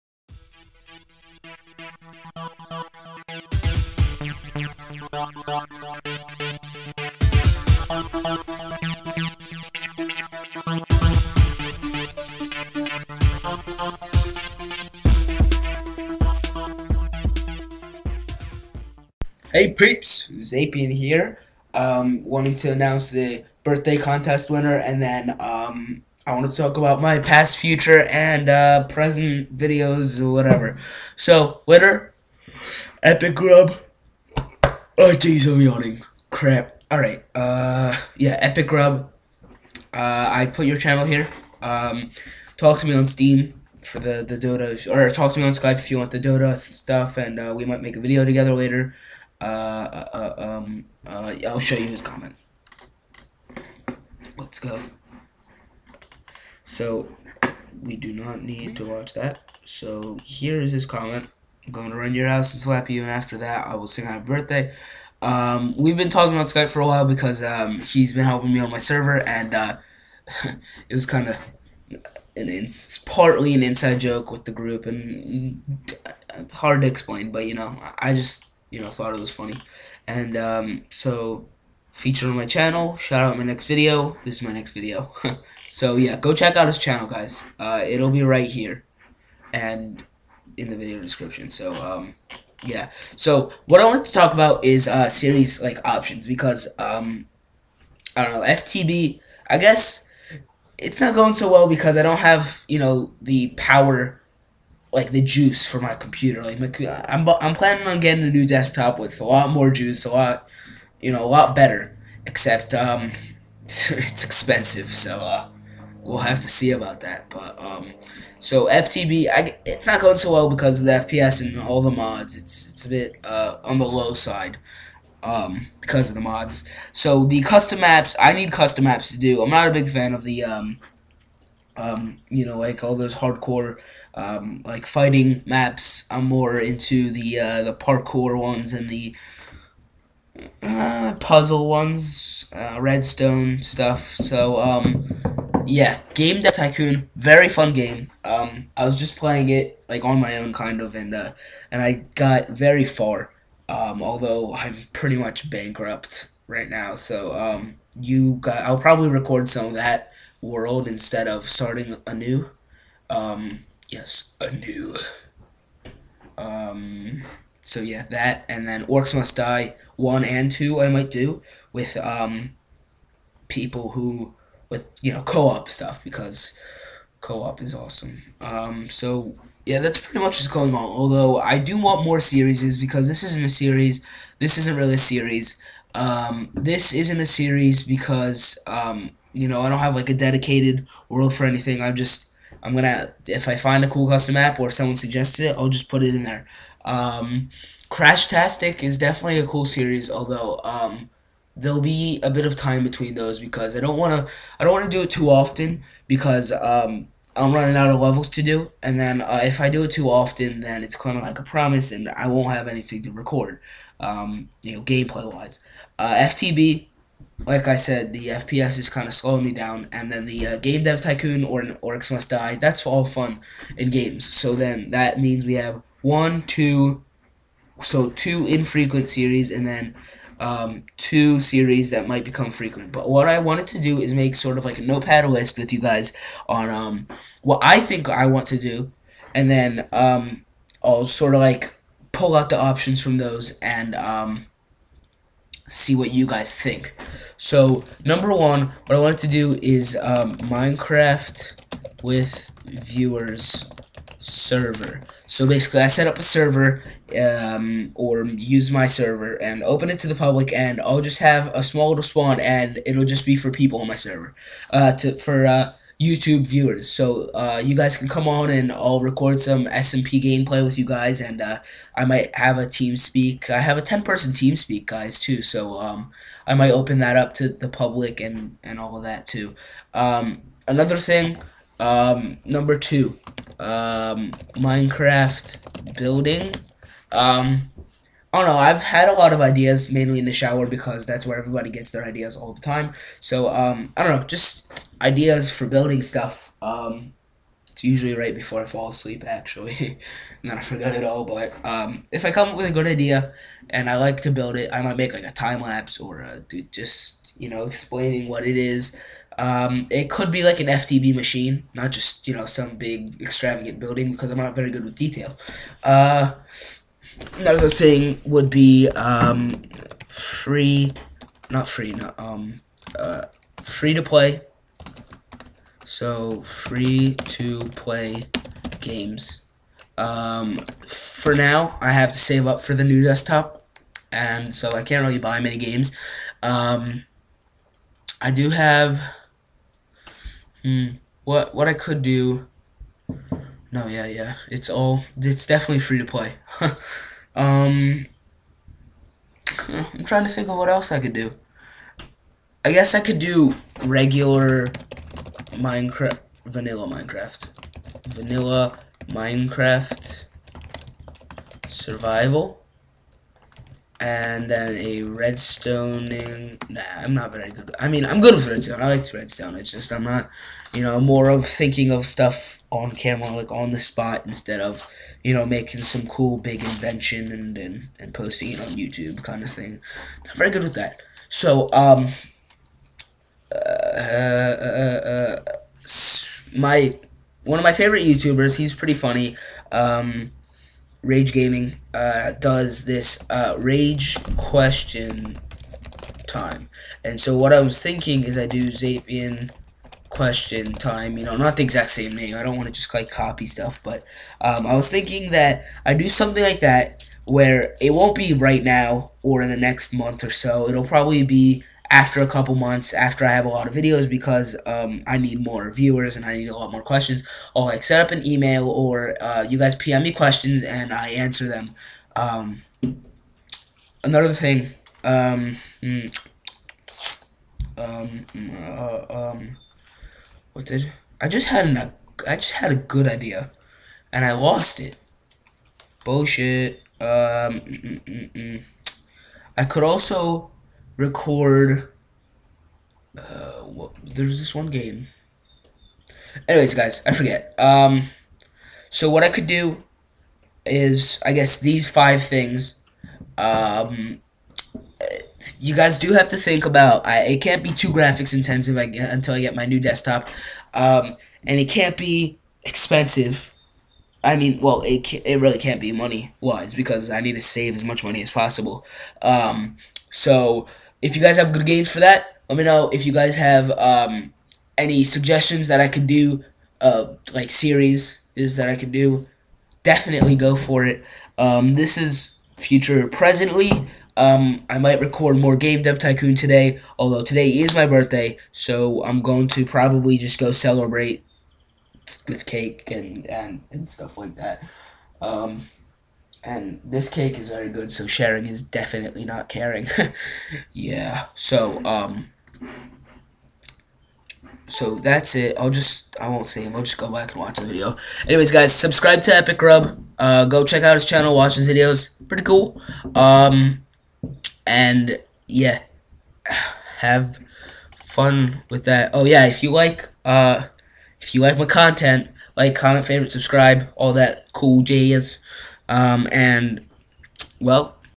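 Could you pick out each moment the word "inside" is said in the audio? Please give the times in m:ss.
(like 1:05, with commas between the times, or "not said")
1:13.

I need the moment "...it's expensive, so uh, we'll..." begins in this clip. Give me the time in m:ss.
1:53.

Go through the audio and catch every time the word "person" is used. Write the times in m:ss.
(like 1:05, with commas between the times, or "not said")
4:34.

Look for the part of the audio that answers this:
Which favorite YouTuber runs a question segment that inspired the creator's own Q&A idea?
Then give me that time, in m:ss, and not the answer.
6:31.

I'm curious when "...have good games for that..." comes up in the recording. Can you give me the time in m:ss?
7:51.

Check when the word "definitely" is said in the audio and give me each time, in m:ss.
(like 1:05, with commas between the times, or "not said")
3:18, 5:45, 7:59, 8:18.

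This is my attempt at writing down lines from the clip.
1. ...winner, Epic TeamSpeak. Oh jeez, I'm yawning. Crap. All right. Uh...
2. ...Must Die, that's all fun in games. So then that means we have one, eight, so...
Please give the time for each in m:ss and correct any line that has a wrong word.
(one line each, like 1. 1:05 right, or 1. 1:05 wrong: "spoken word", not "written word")
1. 0:31 wrong: "Grub", not "TeamSpeak"
2. 3:42 wrong: "two", not "eight".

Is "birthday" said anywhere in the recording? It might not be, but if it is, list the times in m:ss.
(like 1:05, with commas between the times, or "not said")
0:23, 1:04, 8:07.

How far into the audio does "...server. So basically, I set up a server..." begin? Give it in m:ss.
4:14.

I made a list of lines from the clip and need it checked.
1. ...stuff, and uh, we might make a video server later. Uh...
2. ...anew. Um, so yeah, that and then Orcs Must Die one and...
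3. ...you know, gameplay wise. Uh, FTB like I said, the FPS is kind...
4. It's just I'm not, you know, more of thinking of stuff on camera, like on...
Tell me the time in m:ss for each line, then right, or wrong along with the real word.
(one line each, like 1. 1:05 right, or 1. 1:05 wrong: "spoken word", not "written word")
1. 0:46 wrong: "together", not "server"
2. 2:44 right
3. 3:34 right
4. 6:09 right.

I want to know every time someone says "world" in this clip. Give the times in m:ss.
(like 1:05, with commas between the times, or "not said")
2:40, 3:11.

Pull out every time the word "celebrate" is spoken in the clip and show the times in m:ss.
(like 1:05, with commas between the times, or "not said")
8:10.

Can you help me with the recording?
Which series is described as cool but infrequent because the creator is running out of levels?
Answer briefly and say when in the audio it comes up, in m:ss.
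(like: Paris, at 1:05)
Crash Tastic, at 3:17.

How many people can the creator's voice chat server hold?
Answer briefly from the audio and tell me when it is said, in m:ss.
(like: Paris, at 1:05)
10, at 4:33.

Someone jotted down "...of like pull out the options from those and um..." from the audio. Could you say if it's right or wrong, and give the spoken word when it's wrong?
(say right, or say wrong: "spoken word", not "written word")
right.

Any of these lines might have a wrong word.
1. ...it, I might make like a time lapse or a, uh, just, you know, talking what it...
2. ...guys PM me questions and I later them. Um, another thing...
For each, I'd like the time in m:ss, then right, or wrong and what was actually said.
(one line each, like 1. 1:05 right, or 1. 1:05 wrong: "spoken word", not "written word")
1. 5:04 wrong: "explaining", not "talking"
2. 6:59 wrong: "answer", not "later".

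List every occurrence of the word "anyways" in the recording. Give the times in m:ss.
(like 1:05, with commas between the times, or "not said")
7:26, 8:28.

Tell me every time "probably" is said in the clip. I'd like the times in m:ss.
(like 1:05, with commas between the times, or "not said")
2:38, 6:50, 8:09.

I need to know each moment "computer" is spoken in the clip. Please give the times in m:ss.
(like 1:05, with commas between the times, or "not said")
1:45.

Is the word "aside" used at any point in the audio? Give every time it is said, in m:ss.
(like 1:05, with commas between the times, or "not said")
not said.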